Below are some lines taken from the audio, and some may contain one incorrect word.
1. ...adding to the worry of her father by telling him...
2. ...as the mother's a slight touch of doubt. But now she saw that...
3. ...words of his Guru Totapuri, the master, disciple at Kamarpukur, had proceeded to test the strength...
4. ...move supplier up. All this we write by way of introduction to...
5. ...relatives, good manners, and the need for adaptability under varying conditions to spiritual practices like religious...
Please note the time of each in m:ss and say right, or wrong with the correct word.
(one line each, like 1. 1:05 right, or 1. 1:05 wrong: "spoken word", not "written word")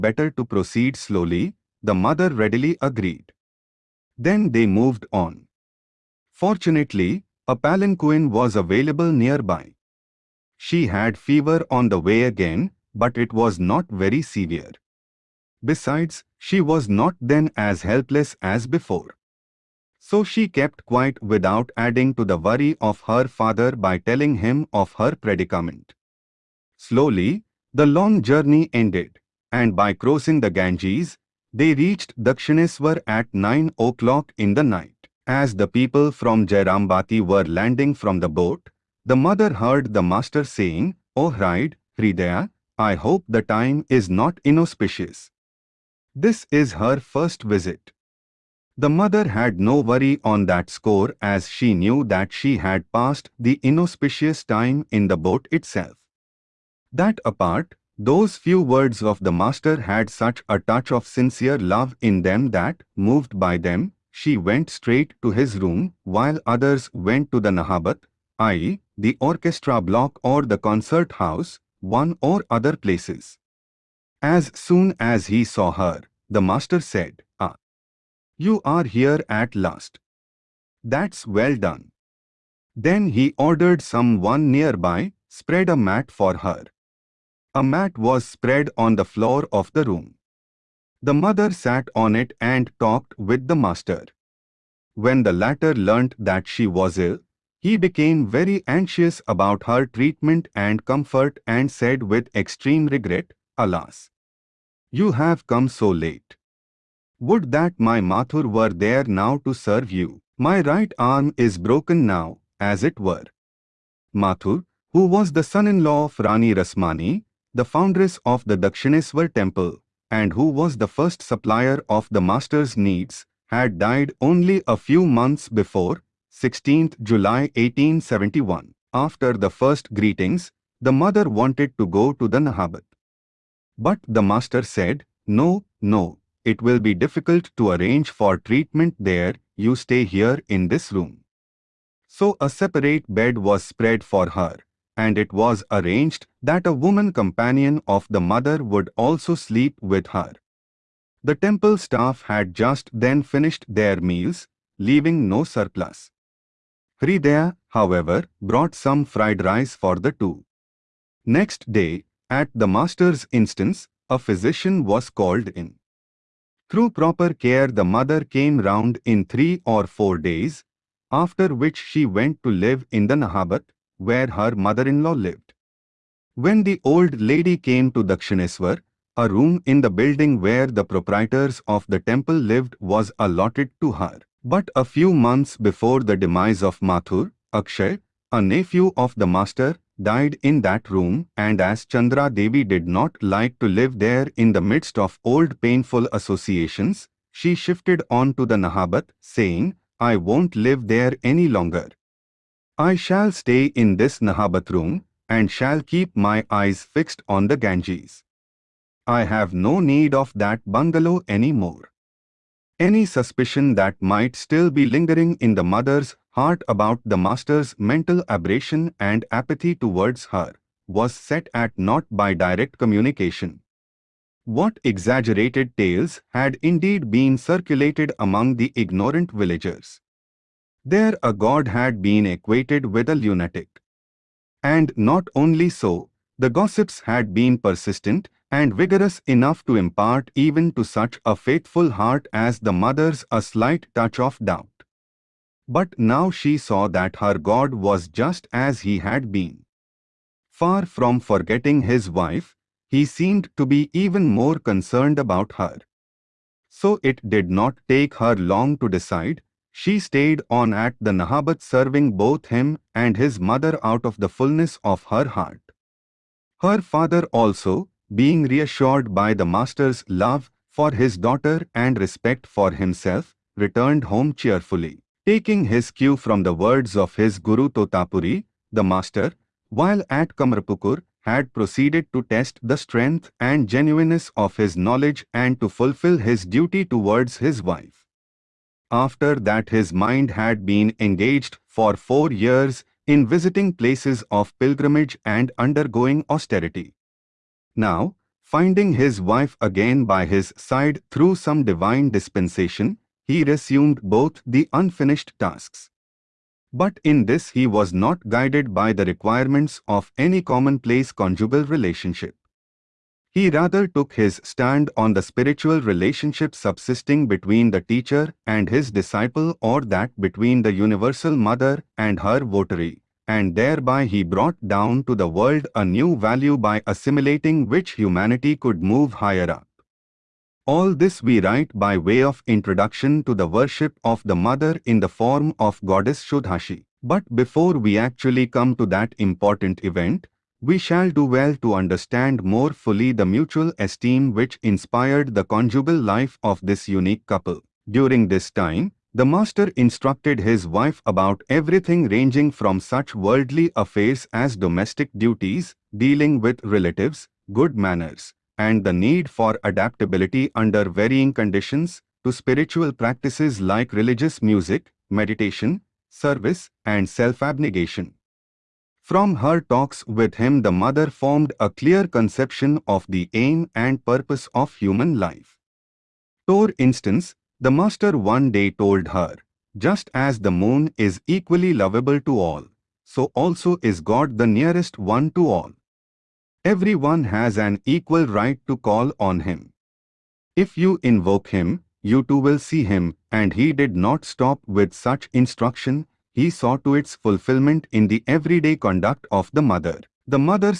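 1. 0:21 right
2. 4:02 right
3. 4:36 wrong: "while", not "disciple"
4. 5:28 wrong: "higher", not "supplier"
5. 5:56 right.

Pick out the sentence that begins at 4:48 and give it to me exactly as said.
After that his mind had been engaged for four years in visiting places of pilgrimage and undergoing austerity.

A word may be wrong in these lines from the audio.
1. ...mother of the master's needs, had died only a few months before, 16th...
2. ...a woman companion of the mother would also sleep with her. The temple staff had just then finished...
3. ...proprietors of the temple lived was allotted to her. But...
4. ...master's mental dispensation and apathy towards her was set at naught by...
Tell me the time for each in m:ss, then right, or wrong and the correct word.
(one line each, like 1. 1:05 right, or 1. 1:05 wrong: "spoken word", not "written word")
1. 2:01 wrong: "supplier", not "mother"
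2. 2:26 right
3. 3:00 right
4. 3:37 wrong: "aberration", not "dispensation".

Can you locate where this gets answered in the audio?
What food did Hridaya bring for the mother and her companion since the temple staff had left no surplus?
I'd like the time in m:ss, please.
2:39.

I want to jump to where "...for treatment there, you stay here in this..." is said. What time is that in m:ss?
2:18.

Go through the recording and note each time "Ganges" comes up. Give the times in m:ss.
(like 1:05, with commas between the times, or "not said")
0:30, 3:27.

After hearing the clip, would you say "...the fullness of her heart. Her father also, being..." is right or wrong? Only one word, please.
right.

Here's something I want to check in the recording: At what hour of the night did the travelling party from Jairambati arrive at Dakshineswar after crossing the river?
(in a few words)
9 o'clock.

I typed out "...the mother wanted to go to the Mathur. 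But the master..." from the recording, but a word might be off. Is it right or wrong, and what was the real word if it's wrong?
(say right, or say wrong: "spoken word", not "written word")
wrong: "Nahabat", not "Mathur".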